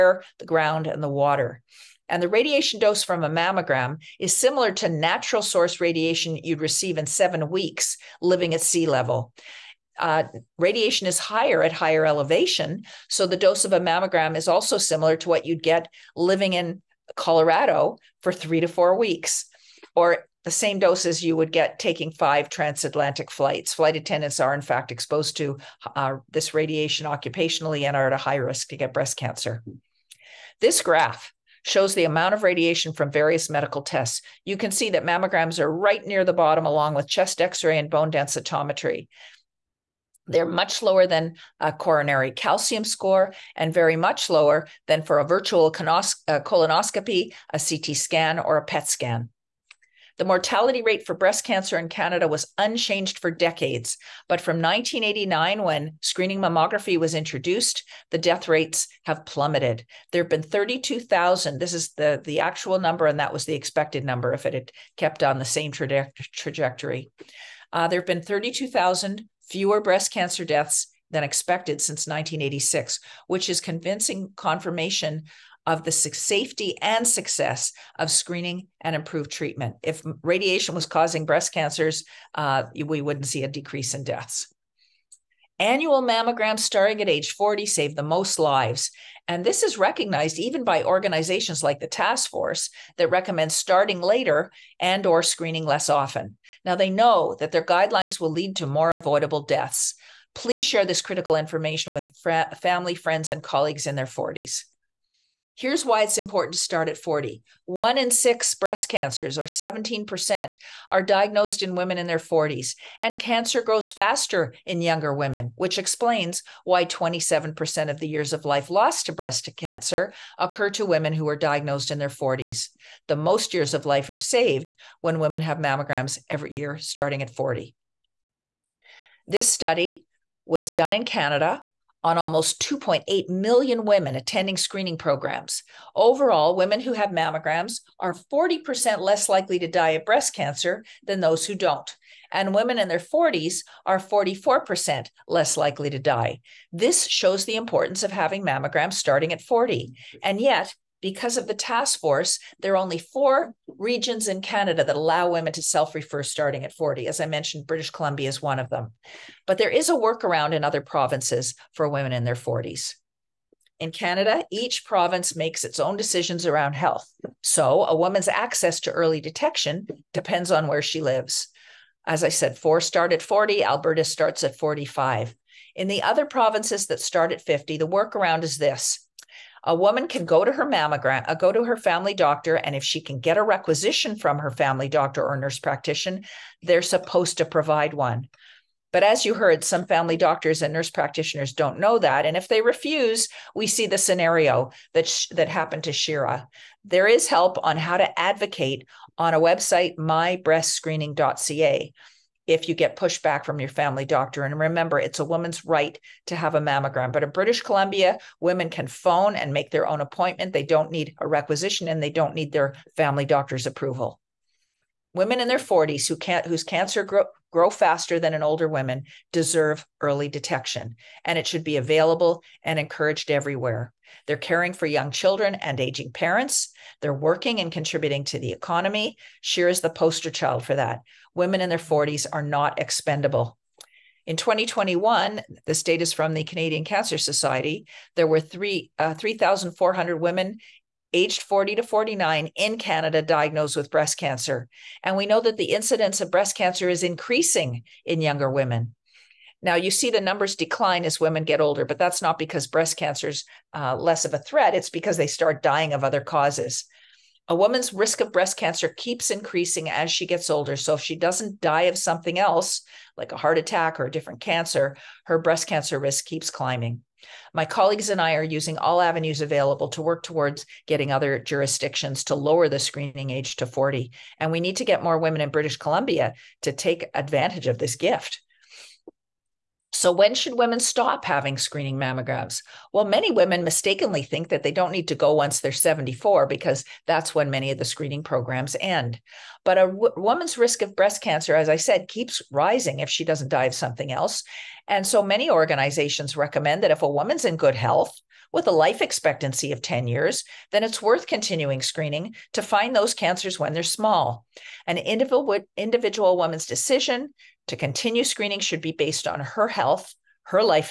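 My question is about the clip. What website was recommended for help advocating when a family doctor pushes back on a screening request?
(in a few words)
mybreastscreening.ca.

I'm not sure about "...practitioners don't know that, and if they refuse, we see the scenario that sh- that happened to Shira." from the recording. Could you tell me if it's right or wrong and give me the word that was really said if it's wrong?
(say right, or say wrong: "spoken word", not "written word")
right.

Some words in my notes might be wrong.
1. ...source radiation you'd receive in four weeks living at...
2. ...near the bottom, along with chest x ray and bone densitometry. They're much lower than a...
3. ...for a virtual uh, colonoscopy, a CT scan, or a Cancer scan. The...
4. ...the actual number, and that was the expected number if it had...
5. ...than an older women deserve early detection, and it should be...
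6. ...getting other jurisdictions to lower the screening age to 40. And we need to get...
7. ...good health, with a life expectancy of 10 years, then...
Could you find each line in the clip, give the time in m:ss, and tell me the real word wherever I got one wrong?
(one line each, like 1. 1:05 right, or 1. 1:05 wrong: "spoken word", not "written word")
1. 0:05 wrong: "seven", not "four"
2. 0:36 right
3. 0:45 wrong: "PET", not "Cancer"
4. 1:02 right
5. 3:38 right
6. 4:30 right
7. 4:57 right.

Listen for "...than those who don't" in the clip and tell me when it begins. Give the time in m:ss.
2:21.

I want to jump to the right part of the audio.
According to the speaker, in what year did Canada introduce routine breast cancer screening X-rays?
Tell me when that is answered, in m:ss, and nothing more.
0:54.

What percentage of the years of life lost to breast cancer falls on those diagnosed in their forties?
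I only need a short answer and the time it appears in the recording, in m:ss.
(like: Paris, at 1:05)
27%, at 1:56.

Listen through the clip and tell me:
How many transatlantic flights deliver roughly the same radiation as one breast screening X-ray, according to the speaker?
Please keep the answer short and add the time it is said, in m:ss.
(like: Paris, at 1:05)
5, at 0:22.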